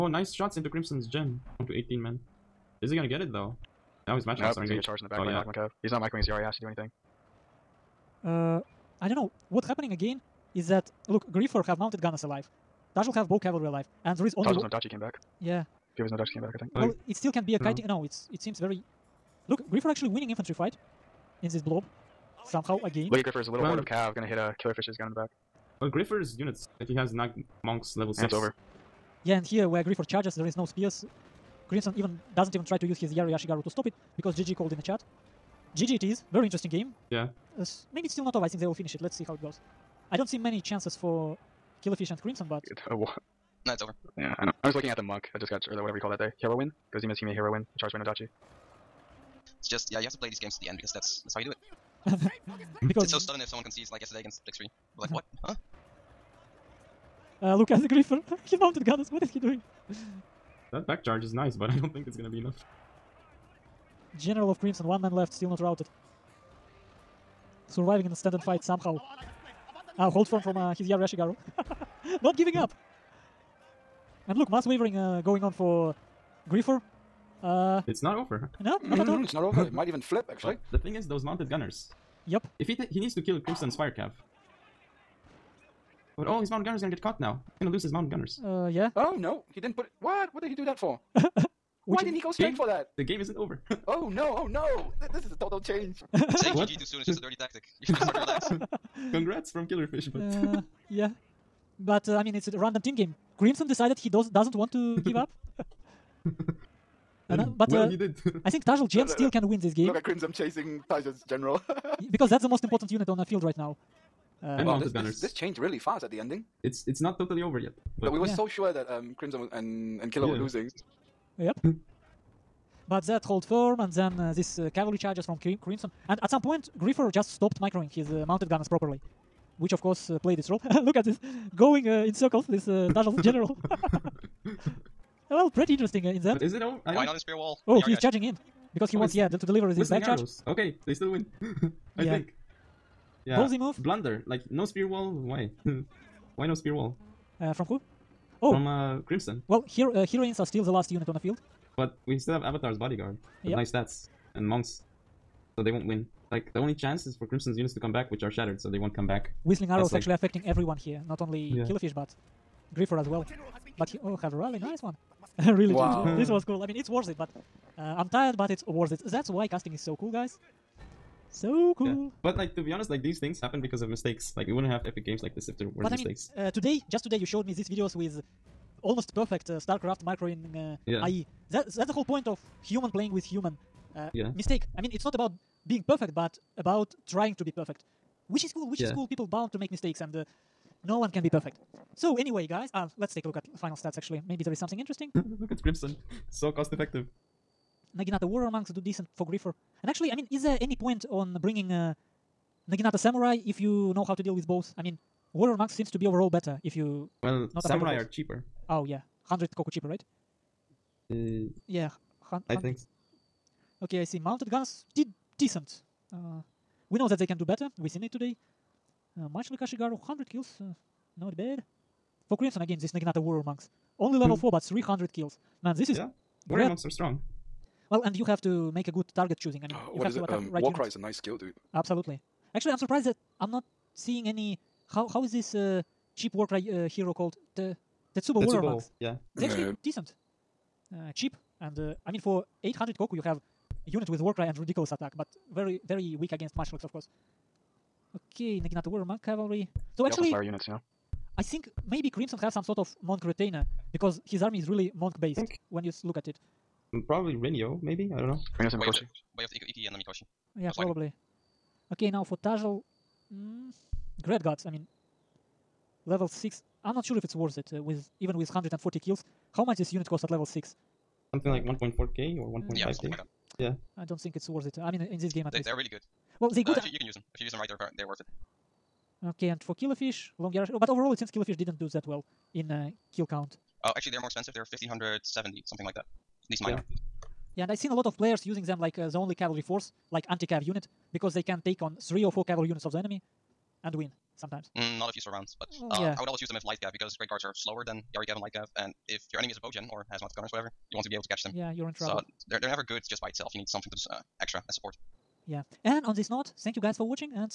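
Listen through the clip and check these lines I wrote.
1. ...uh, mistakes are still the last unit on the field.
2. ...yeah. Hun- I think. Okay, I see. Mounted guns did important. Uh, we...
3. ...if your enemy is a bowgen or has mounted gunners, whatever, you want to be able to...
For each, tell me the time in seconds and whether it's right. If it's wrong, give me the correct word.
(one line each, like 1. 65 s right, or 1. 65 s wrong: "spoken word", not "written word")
1. 149 s wrong: "heroines", not "mistakes"
2. 211 s wrong: "decent", not "important"
3. 299 s right.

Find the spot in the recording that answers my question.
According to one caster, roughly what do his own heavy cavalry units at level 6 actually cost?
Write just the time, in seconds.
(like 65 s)
284 s.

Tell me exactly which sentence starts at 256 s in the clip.
Mm, probably Renio, maybe I don't know.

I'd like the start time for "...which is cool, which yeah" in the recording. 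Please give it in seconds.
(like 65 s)
188 s.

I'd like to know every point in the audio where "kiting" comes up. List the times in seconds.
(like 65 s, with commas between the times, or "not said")
17 s.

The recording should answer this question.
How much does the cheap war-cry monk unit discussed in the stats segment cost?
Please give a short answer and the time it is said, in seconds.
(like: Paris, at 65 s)
800 koku, at 242 s.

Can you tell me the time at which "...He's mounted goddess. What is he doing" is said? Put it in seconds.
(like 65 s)
58 s.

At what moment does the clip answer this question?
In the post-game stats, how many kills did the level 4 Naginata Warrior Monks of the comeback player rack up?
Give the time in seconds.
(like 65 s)
224 s.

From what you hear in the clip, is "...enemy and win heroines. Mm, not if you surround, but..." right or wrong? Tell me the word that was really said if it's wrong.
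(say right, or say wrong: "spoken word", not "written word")
wrong: "sometimes", not "heroines".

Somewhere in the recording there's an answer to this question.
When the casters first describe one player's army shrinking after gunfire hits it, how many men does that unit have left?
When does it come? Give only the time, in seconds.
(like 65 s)
1 s.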